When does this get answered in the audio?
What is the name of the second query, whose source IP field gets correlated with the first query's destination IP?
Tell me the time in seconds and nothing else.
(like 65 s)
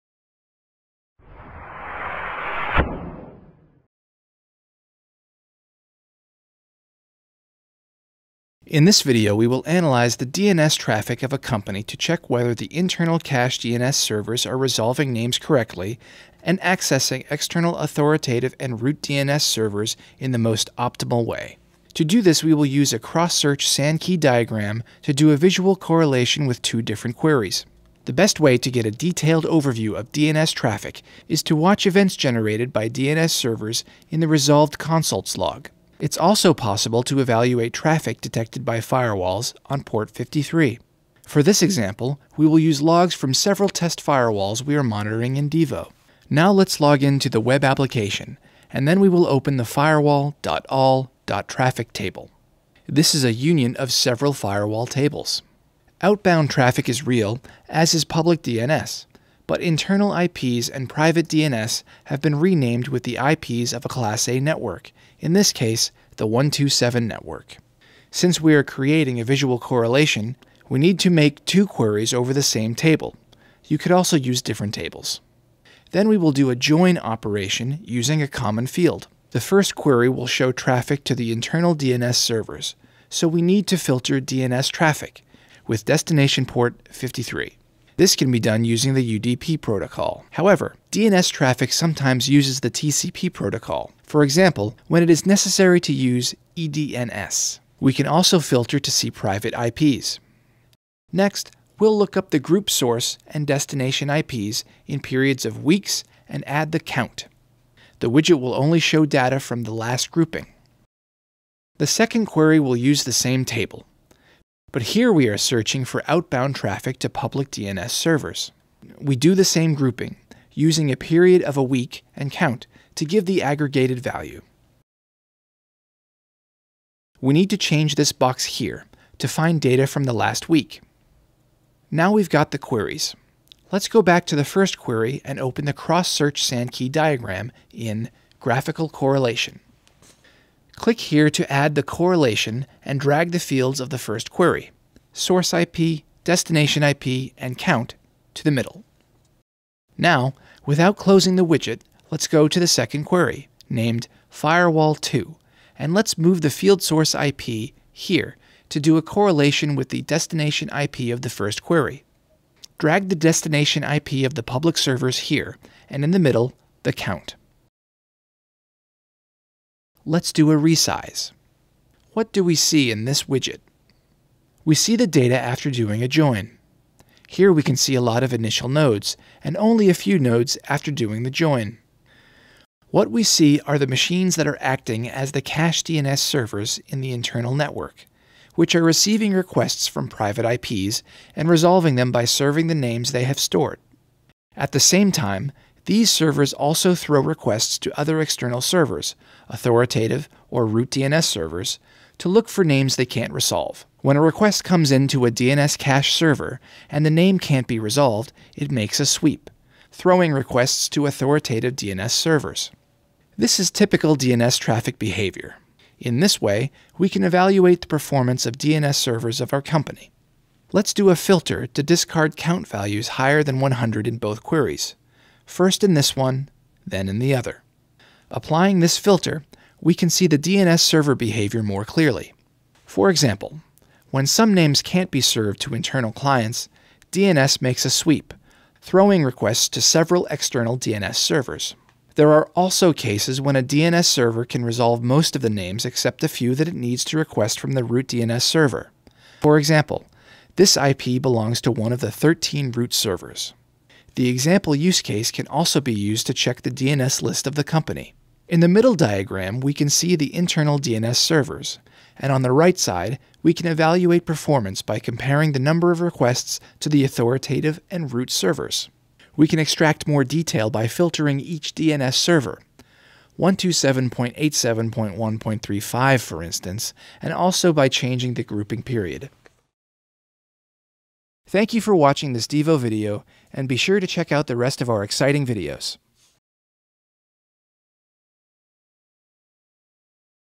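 154 s.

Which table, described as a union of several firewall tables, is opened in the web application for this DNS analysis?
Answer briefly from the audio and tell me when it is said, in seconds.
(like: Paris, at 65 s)
firewall.all.traffic, at 49 s.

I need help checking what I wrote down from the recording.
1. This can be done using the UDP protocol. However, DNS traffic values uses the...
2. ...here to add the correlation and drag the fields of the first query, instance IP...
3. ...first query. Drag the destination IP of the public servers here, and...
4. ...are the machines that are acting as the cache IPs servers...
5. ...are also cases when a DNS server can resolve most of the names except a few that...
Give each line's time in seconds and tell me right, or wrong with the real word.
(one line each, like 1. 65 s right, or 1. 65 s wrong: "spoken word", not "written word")
1. 88 s wrong: "sometimes", not "values"
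2. 140 s wrong: "source", not "instance"
3. 161 s right
4. 183 s wrong: "DNS", not "IPs"
5. 242 s right.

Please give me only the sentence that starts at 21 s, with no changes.
To do this, we will use a cross-search Sankey diagram to do a visual correlation with two different queries.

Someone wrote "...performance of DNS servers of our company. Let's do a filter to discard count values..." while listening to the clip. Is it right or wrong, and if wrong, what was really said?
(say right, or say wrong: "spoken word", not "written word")
right.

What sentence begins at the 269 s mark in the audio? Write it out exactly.
We can extract more detail by filtering each DNS server, 127.87.1.35 for instance, and also by changing the grouping period.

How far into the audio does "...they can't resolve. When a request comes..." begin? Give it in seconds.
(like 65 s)
202 s.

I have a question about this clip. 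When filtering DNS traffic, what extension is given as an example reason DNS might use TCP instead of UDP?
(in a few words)
EDNS.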